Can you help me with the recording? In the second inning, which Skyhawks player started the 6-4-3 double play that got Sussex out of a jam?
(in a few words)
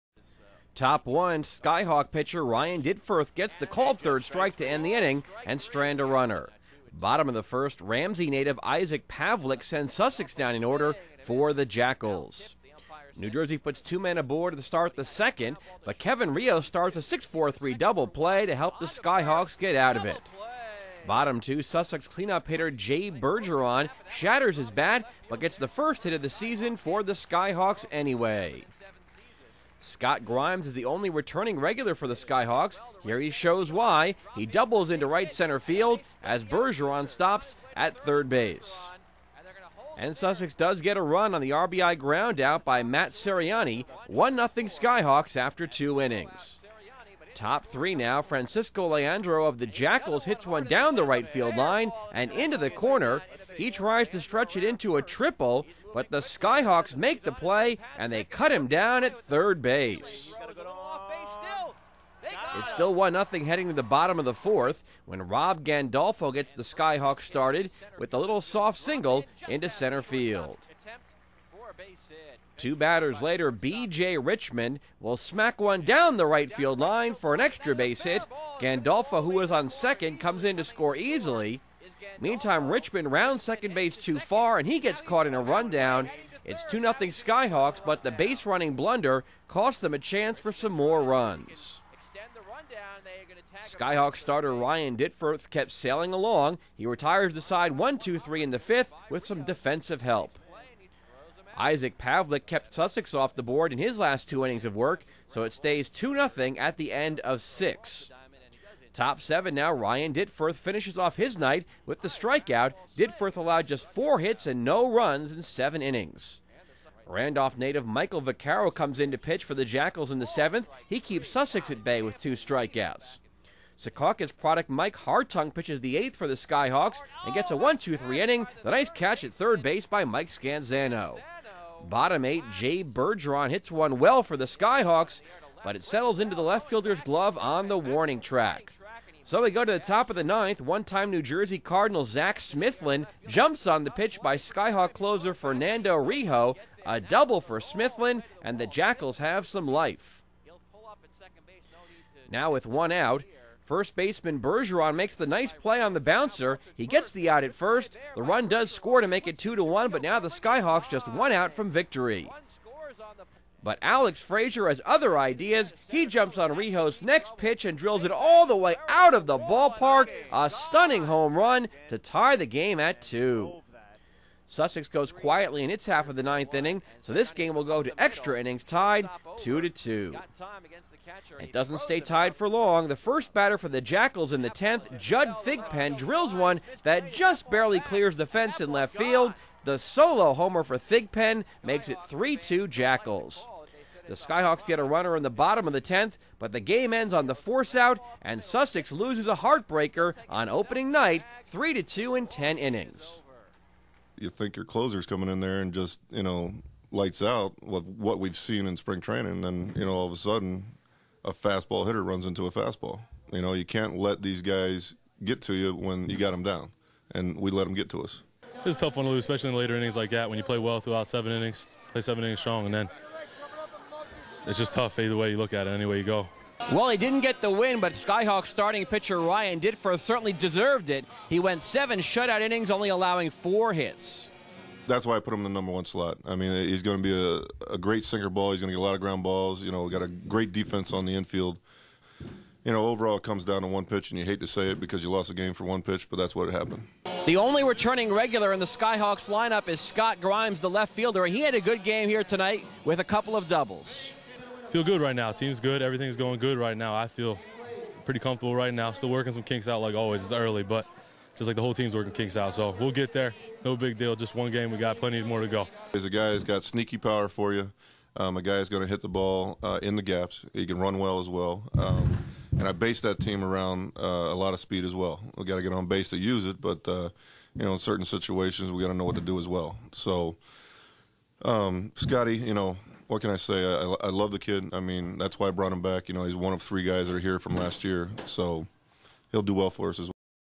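Kevin Rios.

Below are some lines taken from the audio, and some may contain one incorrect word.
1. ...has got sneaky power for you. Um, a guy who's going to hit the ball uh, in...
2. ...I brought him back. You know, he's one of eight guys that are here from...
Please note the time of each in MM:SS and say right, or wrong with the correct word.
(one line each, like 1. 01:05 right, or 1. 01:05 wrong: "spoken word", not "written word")
1. 04:26 right
2. 04:45 wrong: "three", not "eight".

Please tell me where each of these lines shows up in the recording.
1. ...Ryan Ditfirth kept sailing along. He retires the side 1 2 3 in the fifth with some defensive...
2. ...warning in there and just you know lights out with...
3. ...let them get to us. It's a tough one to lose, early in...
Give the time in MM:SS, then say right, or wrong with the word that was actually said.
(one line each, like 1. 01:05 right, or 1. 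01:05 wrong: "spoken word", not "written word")
1. 01:34 right
2. 03:25 wrong: "coming", not "warning"
3. 03:37 wrong: "especially", not "early".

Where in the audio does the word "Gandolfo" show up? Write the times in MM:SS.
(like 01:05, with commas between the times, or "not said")
01:05, 01:18.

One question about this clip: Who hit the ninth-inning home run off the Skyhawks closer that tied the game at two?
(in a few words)
Alex Frazier.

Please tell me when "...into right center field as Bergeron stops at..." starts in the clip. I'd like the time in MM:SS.
00:34.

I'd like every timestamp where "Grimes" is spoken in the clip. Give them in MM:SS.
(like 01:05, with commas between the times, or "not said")
00:30, 04:10.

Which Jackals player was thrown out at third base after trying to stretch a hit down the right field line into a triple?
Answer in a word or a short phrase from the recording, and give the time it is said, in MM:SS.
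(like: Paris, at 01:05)
Francisco Leandro, at 00:48.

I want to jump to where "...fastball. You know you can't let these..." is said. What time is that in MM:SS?
03:32.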